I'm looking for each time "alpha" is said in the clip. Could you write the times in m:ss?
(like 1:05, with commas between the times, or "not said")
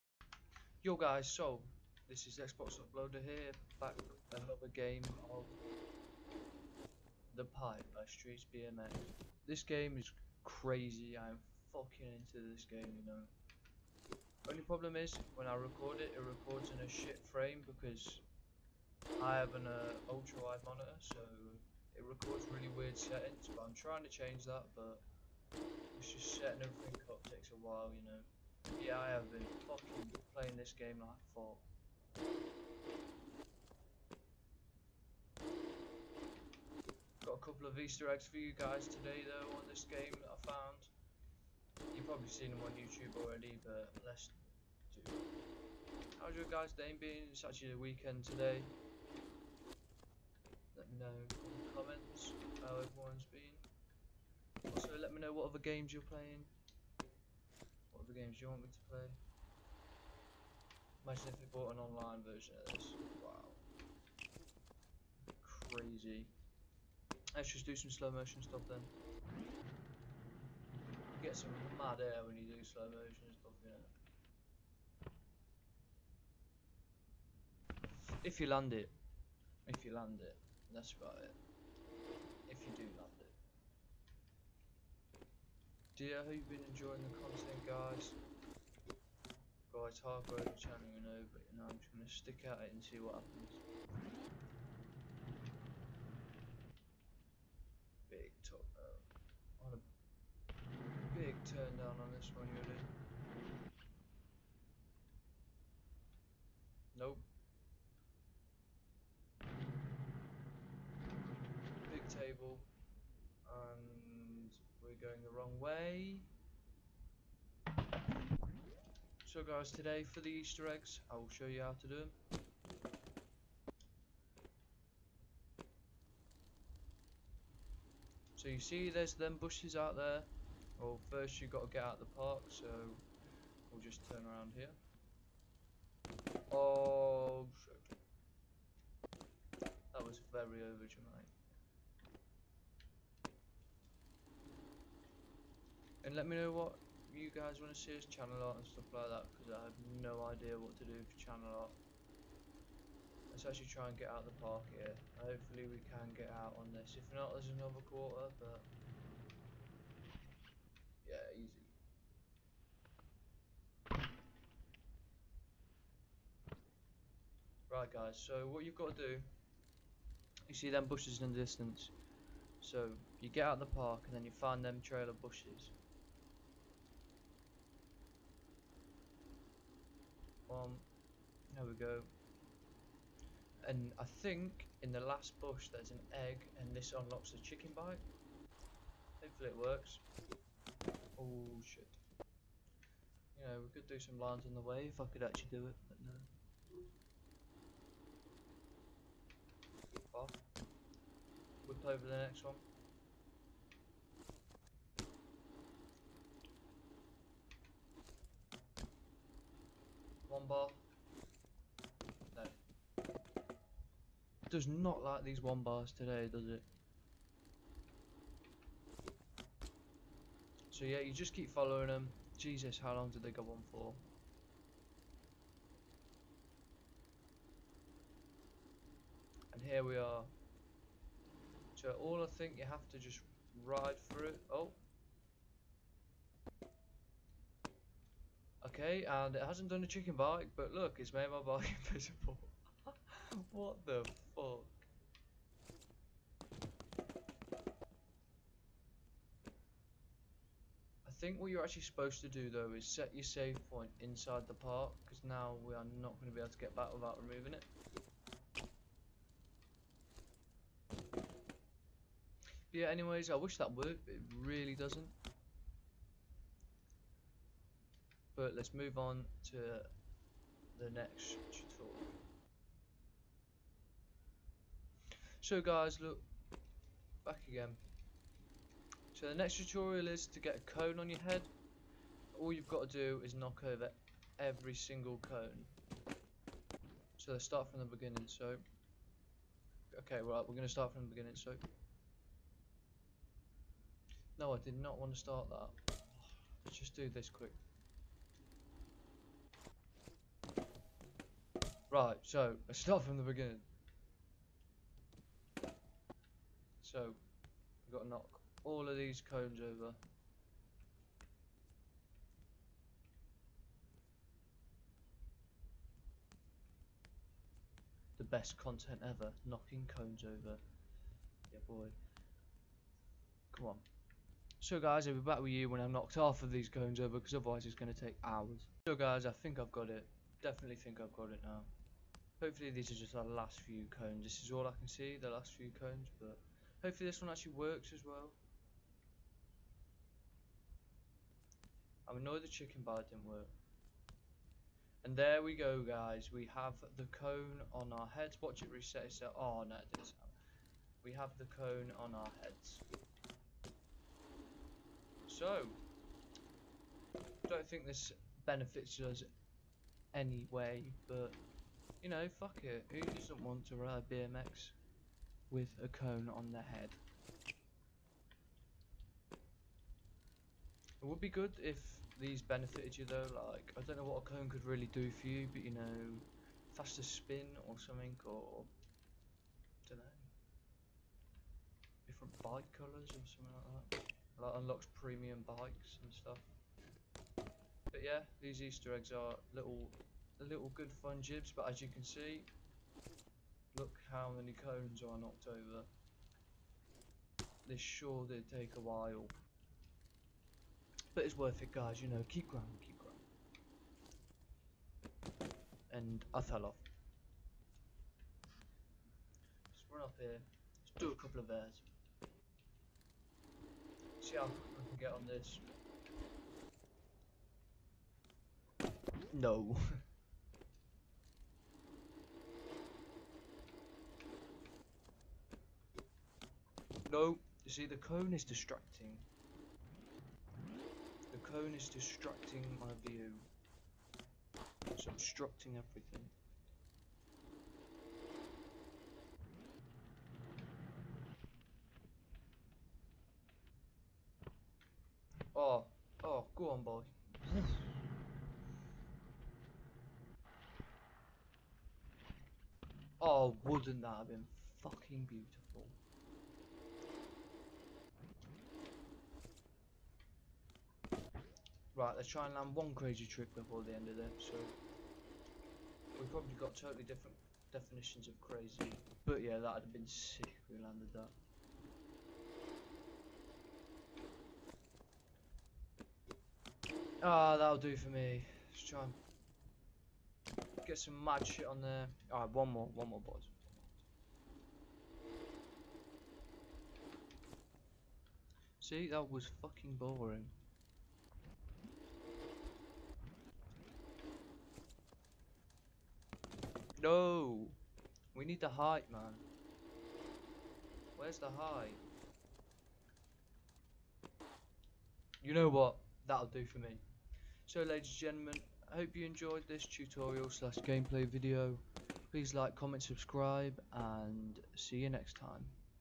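not said.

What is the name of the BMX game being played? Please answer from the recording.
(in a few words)
Streets BMX.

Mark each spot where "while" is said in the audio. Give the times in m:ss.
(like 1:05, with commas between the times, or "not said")
0:27, 6:38.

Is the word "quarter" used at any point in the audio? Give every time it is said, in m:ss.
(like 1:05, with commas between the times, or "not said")
2:37.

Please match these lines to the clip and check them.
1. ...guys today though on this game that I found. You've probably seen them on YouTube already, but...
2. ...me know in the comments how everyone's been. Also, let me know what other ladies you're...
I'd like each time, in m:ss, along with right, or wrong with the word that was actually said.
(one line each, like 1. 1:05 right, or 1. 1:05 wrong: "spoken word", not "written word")
1. 0:38 right
2. 0:50 wrong: "games", not "ladies".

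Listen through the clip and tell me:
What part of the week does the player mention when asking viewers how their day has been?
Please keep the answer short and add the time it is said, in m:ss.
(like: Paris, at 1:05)
weekend, at 0:47.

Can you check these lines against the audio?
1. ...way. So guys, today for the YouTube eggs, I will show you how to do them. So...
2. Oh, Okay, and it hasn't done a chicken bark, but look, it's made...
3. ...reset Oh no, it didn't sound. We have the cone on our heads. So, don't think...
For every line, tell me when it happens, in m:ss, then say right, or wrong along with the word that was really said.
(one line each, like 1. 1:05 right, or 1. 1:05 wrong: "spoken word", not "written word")
1. 1:55 wrong: "Easter", not "YouTube"
2. 3:54 right
3. 5:48 right.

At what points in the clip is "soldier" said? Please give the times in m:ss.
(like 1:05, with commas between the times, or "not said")
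not said.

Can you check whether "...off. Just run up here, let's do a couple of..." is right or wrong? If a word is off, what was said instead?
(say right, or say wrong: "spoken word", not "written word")
right.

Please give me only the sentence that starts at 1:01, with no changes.
Imagine if they bought an online version of this.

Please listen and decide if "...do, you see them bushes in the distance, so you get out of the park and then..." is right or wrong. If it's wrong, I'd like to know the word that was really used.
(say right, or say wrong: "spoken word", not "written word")
right.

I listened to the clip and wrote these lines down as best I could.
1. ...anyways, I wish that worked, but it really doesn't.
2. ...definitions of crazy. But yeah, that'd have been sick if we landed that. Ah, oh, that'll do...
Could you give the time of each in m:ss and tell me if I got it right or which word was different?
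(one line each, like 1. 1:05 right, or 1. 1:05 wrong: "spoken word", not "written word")
1. 4:22 right
2. 7:47 right.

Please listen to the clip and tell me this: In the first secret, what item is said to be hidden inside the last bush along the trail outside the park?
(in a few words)
egg.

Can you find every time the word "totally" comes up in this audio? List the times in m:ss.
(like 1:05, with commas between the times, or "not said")
7:46.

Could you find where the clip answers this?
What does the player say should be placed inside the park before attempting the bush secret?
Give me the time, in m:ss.
4:13.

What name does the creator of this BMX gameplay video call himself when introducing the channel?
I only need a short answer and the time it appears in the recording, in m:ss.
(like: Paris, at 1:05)
Xbox Uploader, at 0:02.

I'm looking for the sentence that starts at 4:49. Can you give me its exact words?
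Okay, right, we're going to start from the beginning, so...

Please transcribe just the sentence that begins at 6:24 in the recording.
Like, unlocks premium bikes and stuff.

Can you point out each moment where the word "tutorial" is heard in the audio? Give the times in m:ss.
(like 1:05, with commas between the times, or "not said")
4:31, 4:39, 8:29.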